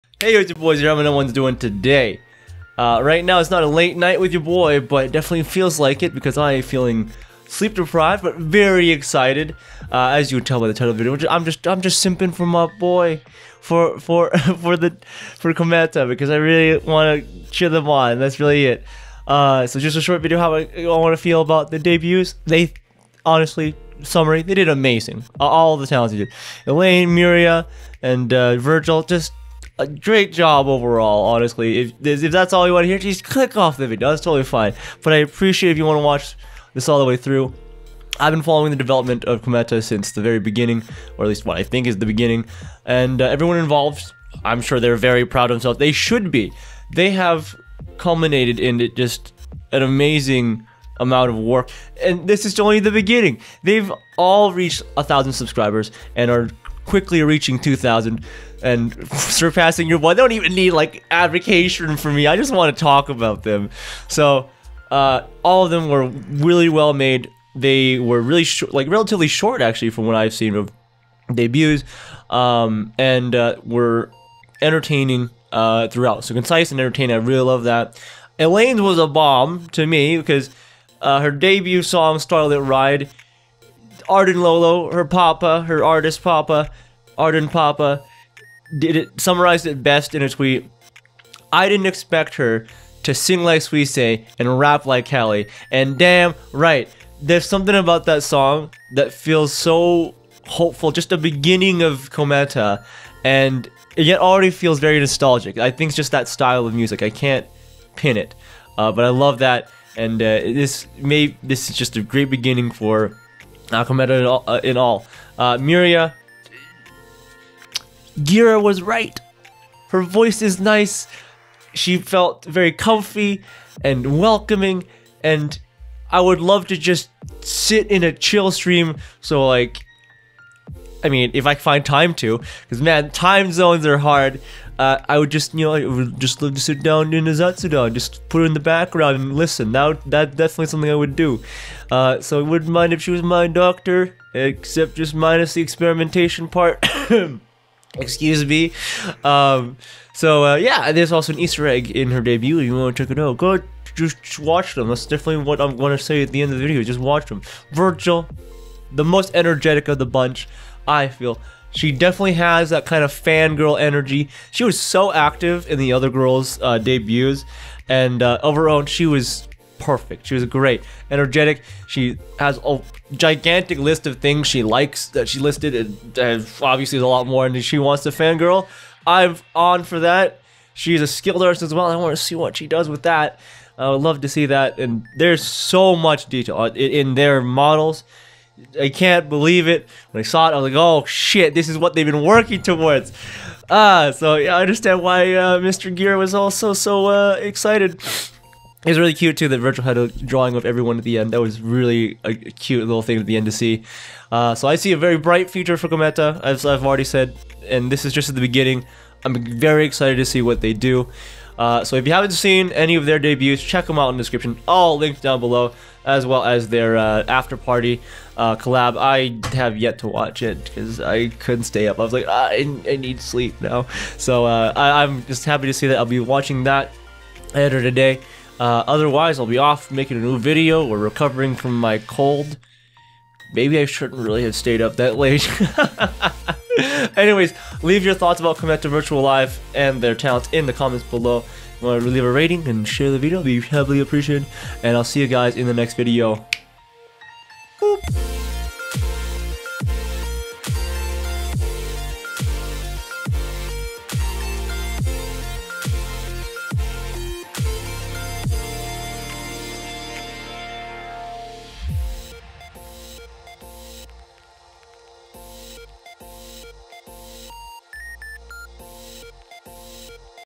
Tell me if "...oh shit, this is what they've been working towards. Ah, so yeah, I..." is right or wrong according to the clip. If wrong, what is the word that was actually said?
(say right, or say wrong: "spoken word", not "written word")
right.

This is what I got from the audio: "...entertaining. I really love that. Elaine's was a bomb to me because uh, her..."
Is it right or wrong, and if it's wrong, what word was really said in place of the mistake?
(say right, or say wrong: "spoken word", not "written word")
right.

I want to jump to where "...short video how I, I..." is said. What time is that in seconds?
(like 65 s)
20 s.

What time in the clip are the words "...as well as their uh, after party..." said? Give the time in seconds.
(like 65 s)
216 s.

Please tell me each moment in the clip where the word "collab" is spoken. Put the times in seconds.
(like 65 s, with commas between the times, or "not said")
218 s.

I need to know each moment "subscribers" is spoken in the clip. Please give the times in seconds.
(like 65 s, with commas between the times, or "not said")
55 s.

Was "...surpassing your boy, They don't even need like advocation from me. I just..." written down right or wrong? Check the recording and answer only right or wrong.
right.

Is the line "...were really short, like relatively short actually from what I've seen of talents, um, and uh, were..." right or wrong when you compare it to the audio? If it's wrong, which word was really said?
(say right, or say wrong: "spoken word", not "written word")
wrong: "debuts", not "talents".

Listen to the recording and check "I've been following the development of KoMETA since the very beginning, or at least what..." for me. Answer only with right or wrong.
right.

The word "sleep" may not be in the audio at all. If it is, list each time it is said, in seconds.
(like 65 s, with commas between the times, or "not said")
7 s, 223 s.